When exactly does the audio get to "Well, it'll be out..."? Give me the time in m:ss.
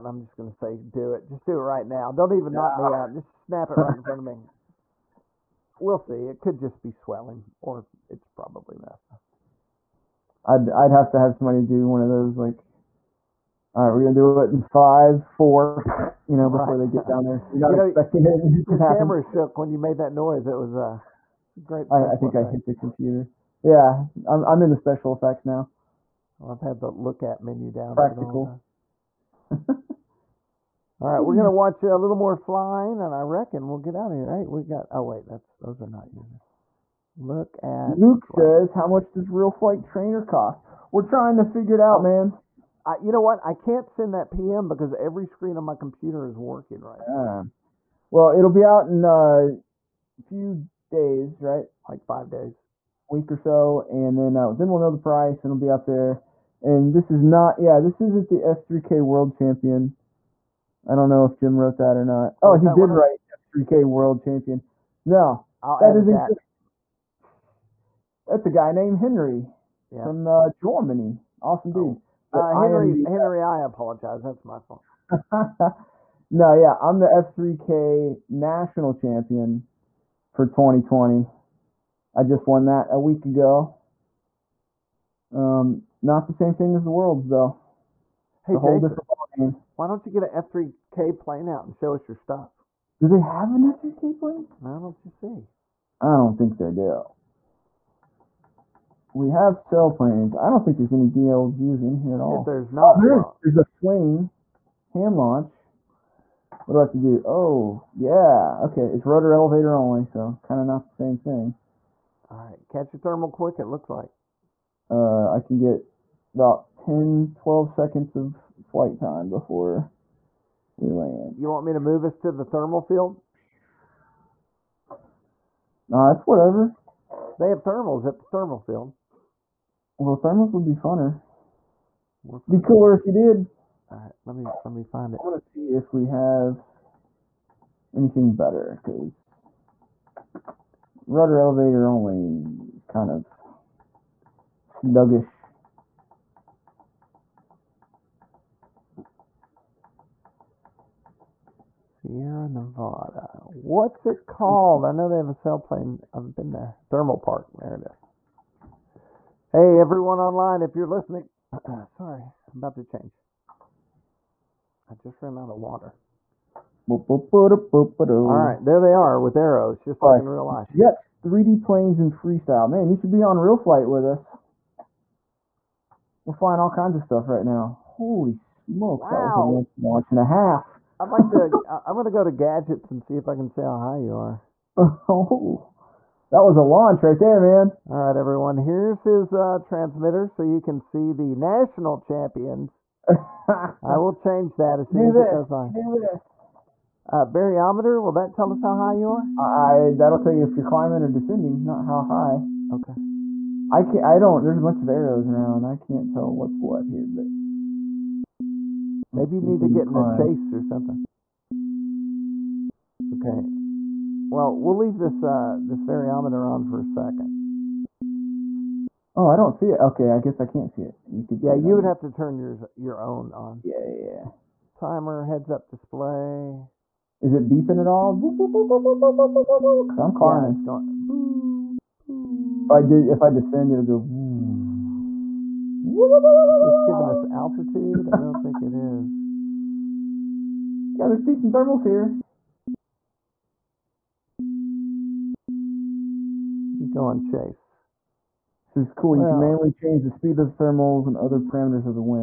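0:48.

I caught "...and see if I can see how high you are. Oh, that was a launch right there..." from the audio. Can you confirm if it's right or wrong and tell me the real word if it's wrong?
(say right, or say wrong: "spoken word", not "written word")
right.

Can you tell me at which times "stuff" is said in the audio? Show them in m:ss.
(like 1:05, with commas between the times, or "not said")
1:32, 2:57.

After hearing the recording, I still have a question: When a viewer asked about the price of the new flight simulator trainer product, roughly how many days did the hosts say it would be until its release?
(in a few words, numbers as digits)
5.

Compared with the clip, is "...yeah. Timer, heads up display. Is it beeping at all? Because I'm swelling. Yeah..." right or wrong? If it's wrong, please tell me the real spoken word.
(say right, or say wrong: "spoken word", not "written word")
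wrong: "climbing", not "swelling".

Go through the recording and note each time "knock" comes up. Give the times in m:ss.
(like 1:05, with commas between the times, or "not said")
0:02.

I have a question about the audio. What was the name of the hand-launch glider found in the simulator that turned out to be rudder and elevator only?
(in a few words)
Fling hand launch.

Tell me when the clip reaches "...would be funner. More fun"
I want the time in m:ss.
2:10.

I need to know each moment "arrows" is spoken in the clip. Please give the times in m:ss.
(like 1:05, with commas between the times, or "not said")
2:49, 3:24.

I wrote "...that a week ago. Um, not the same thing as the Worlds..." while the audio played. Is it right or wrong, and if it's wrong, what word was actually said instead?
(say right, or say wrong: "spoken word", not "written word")
right.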